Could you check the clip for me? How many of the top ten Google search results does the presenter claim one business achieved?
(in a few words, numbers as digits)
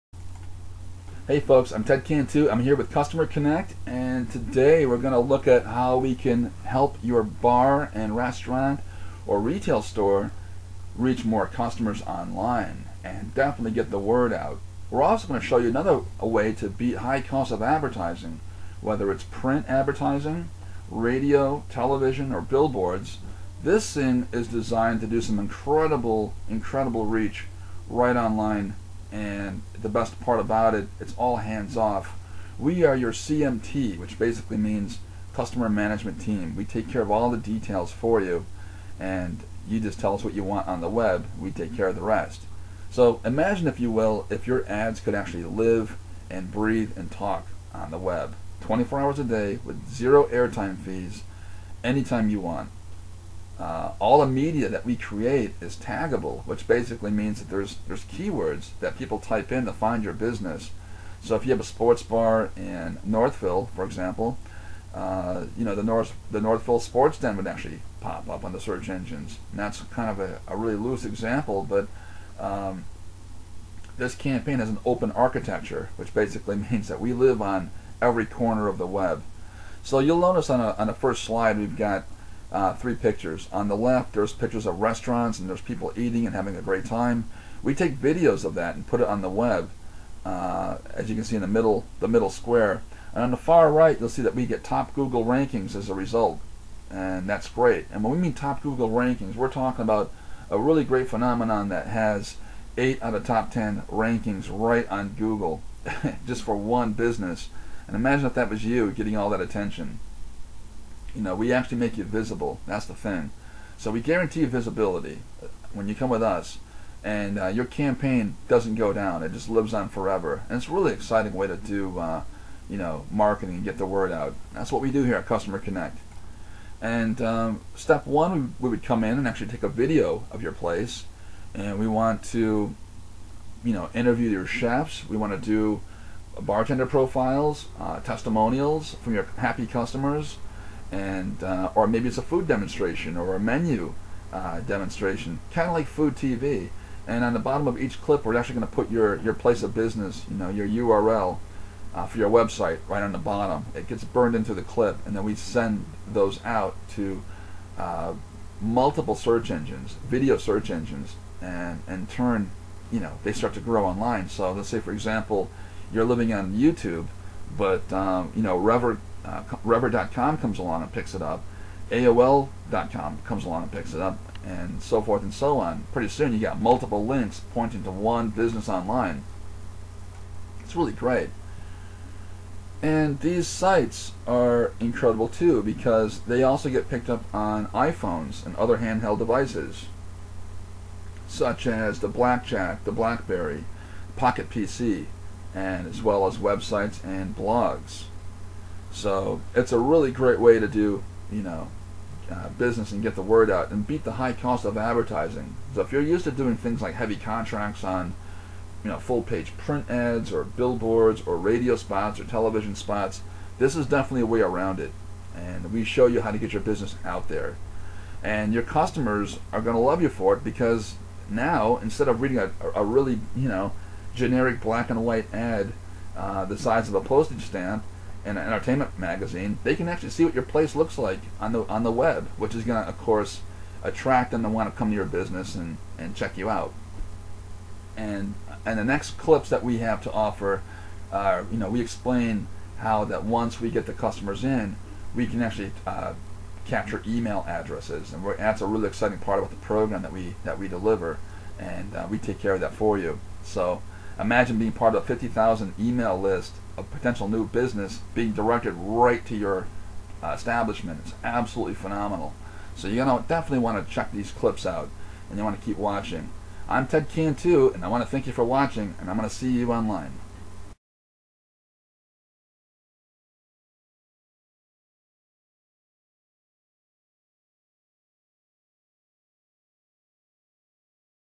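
8.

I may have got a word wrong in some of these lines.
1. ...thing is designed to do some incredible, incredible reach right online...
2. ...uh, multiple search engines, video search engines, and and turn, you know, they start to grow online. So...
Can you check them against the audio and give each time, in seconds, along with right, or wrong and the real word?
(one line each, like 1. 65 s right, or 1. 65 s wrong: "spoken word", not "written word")
1. 23 s right
2. 157 s right.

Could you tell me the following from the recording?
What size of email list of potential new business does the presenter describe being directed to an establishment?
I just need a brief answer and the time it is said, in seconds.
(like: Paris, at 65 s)
50,000, at 255 s.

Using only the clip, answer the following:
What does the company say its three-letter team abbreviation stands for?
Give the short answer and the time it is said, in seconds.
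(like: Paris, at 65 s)
customer management team, at 35 s.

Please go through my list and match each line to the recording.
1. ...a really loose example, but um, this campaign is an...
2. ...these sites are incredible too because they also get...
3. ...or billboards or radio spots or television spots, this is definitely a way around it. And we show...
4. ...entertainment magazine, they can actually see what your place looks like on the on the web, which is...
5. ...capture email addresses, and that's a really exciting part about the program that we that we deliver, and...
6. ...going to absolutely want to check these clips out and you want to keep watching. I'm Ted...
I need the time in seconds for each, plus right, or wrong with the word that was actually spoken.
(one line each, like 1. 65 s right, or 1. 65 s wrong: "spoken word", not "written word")
1. 70 s right
2. 183 s right
3. 210 s right
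4. 228 s right
5. 246 s right
6. 263 s wrong: "definitely", not "absolutely".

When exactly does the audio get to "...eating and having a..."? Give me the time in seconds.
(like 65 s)
85 s.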